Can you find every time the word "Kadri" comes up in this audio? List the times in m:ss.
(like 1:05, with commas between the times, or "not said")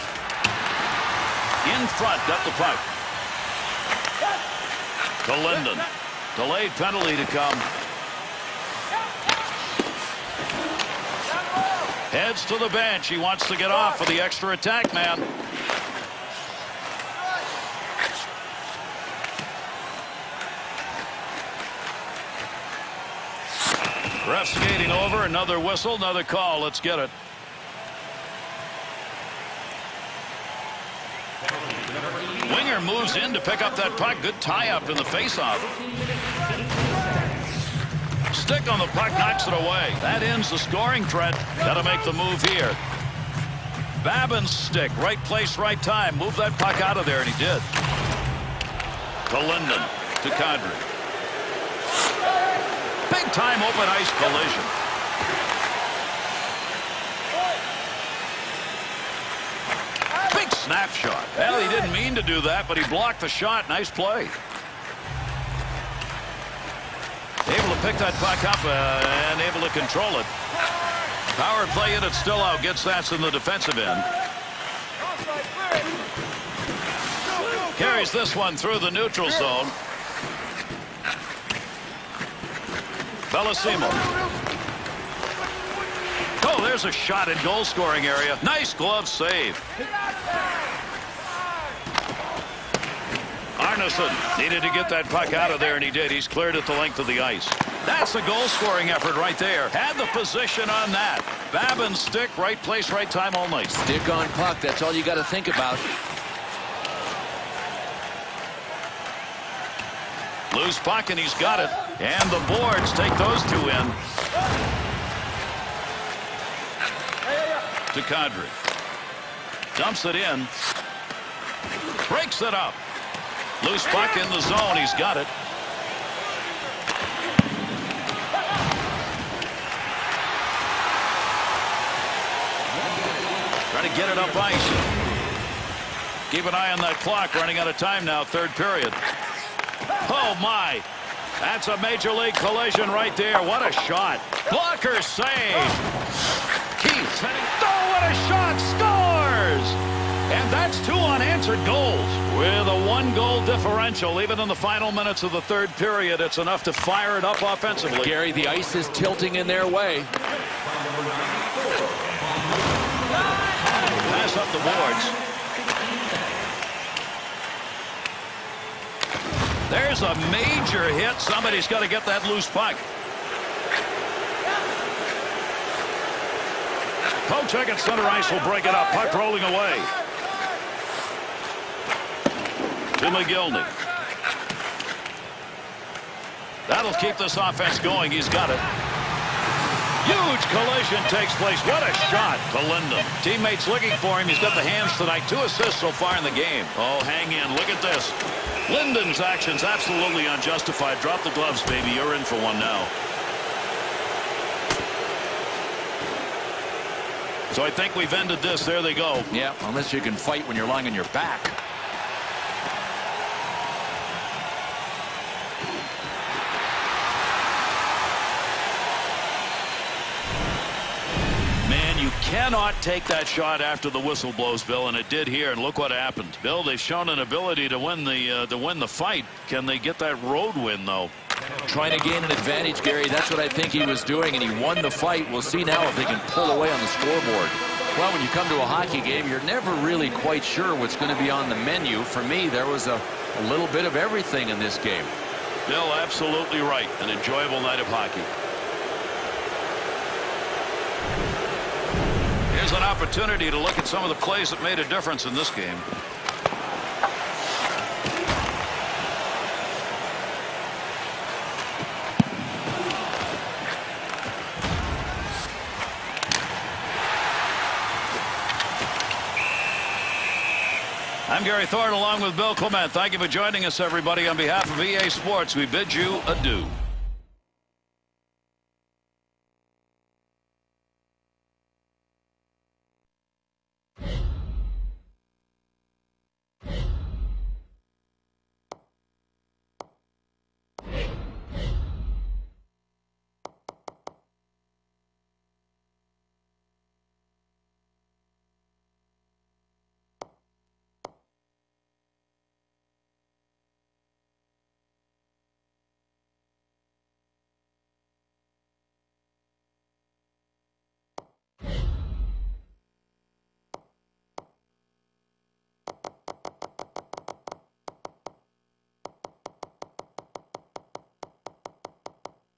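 0:50, 1:58.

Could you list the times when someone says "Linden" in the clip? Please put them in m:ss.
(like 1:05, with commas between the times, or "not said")
0:05, 0:49, 3:18.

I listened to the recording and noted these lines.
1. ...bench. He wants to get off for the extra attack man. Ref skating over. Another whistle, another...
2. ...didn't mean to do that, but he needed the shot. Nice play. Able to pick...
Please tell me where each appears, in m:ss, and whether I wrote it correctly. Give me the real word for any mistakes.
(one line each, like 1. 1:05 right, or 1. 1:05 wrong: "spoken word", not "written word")
1. 0:12 right
2. 1:01 wrong: "blocked", not "needed".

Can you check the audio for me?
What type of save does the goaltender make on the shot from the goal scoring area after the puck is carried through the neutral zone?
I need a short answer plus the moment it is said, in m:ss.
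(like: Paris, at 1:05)
Glove save, at 1:28.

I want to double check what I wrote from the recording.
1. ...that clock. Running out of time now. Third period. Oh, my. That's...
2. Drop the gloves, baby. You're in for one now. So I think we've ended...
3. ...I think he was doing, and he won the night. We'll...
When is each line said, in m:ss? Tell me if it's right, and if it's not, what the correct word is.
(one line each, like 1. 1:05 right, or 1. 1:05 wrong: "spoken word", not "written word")
1. 2:16 right
2. 3:21 right
3. 3:53 wrong: "fight", not "night".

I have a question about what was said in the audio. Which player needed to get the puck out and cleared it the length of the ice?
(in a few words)
Arneson.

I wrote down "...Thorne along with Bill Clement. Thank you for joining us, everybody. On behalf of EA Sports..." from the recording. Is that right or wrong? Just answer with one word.
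right.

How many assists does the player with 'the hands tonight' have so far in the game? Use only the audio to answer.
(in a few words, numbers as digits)
2.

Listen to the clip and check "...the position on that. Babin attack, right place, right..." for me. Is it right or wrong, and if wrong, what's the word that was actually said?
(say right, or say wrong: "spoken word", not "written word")
wrong: "stick", not "attack".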